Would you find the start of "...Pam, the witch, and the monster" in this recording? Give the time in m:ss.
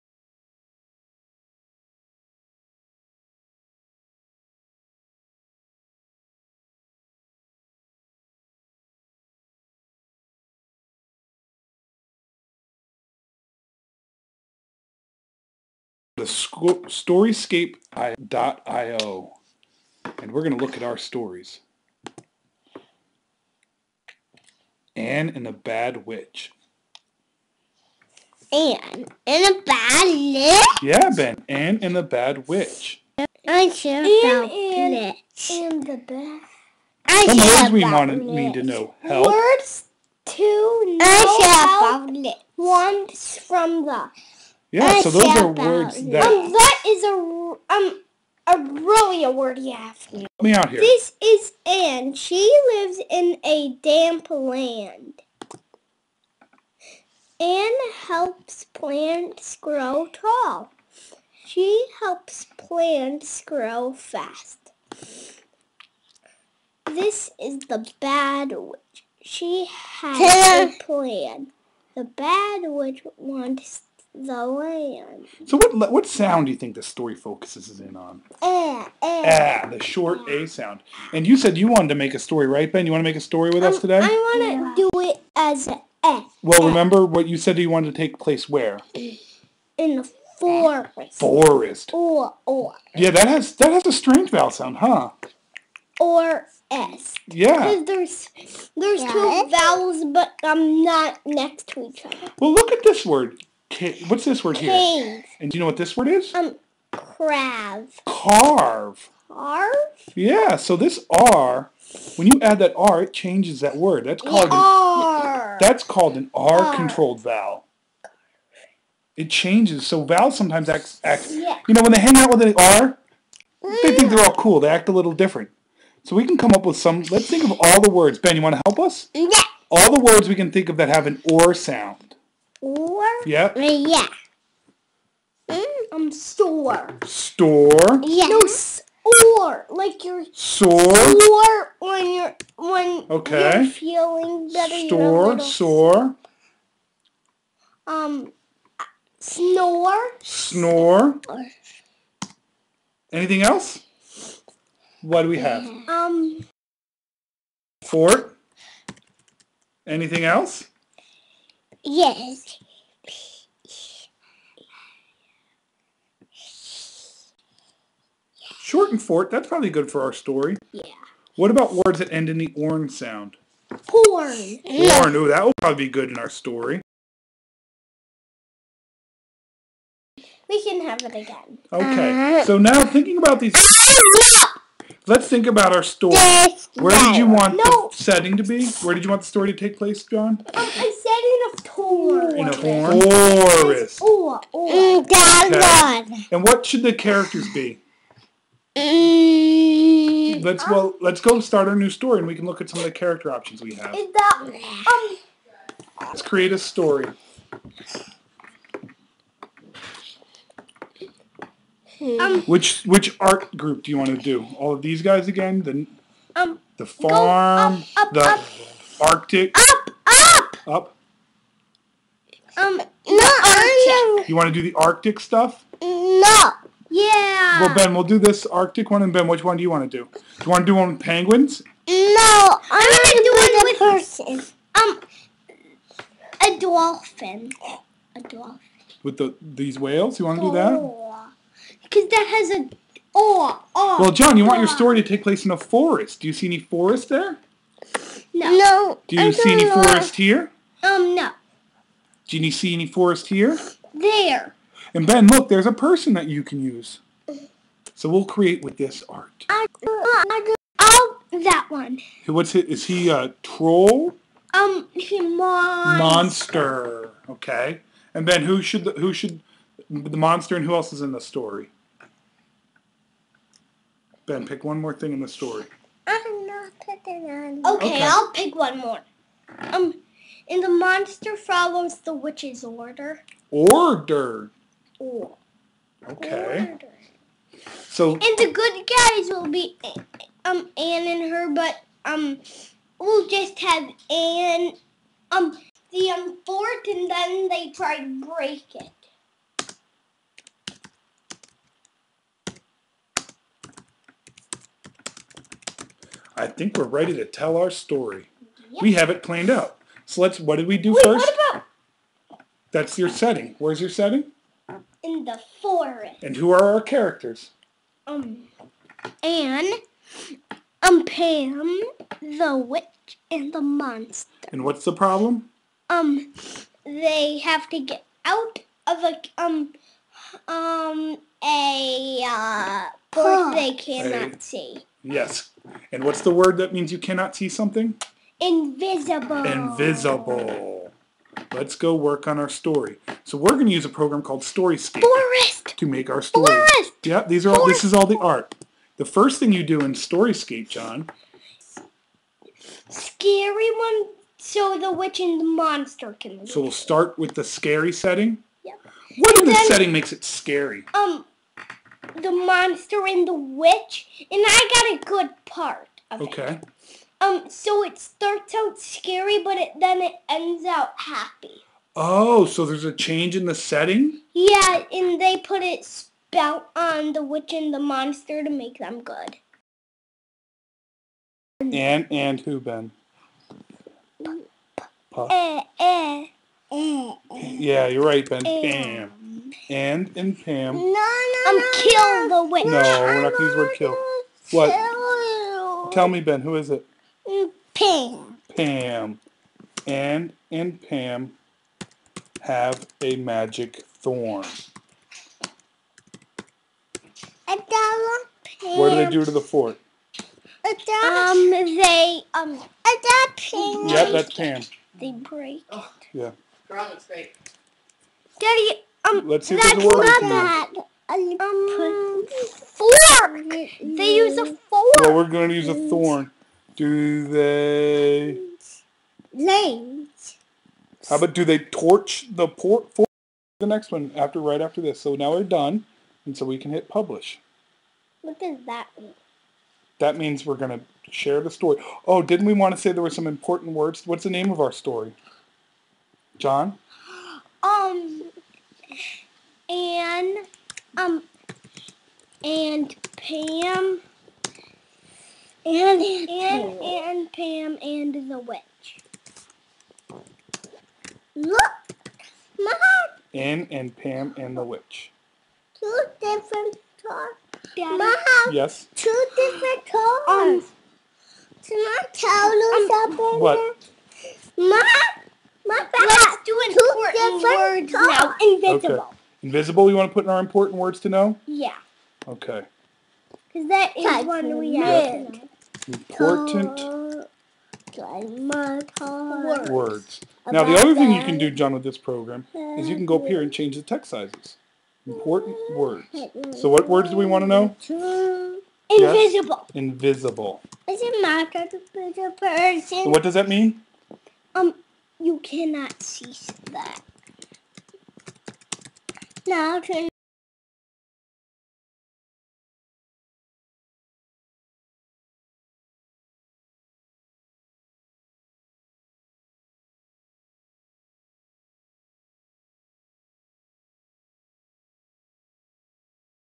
5:21.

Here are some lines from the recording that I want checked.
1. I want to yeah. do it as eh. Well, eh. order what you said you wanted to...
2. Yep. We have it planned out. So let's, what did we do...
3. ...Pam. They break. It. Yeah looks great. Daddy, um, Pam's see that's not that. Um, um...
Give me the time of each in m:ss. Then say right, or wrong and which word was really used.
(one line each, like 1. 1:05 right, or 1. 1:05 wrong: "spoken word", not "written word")
1. 1:24 wrong: "remember", not "order"
2. 5:08 right
3. 6:54 wrong: "Let", not "Pam".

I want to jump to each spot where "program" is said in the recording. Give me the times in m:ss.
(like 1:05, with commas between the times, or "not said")
5:43, 8:11.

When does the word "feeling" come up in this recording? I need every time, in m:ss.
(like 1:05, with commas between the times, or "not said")
2:23.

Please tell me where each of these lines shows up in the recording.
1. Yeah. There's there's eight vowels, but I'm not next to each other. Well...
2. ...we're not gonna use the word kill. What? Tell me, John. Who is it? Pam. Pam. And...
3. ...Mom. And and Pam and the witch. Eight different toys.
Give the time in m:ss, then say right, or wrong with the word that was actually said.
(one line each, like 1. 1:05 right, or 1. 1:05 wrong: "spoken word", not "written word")
1. 1:37 wrong: "two", not "eight"
2. 6:33 wrong: "Ben", not "John"
3. 7:42 wrong: "Two", not "Eight".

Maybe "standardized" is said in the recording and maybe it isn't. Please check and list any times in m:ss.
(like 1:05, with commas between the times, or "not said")
not said.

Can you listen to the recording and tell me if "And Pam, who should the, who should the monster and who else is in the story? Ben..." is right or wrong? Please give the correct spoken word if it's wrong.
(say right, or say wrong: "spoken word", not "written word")
wrong: "Ben", not "Pam".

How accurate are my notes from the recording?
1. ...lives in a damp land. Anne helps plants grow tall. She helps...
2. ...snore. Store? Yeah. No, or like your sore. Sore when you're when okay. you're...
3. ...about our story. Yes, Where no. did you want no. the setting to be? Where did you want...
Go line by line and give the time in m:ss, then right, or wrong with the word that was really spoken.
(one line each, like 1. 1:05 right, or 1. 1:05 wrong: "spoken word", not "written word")
1. 0:52 right
2. 2:16 wrong: "store", not "snore"
3. 3:05 right.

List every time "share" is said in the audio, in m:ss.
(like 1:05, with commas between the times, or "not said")
7:21.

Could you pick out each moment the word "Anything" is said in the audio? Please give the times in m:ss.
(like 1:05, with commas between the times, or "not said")
2:33, 2:39.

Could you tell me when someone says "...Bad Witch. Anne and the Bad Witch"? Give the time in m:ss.
0:25.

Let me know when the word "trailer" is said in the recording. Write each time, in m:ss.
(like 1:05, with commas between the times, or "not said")
not said.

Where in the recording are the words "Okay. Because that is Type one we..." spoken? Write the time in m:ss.
8:02.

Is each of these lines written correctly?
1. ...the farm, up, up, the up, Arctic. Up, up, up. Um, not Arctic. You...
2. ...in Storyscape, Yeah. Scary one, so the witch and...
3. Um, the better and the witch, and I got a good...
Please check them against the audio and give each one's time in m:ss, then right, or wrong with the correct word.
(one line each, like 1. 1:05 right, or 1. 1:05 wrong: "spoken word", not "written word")
1. 3:36 right
2. 5:49 wrong: "John", not "Yeah"
3. 6:00 wrong: "monster", not "better".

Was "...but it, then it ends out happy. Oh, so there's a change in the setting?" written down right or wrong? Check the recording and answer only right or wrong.
right.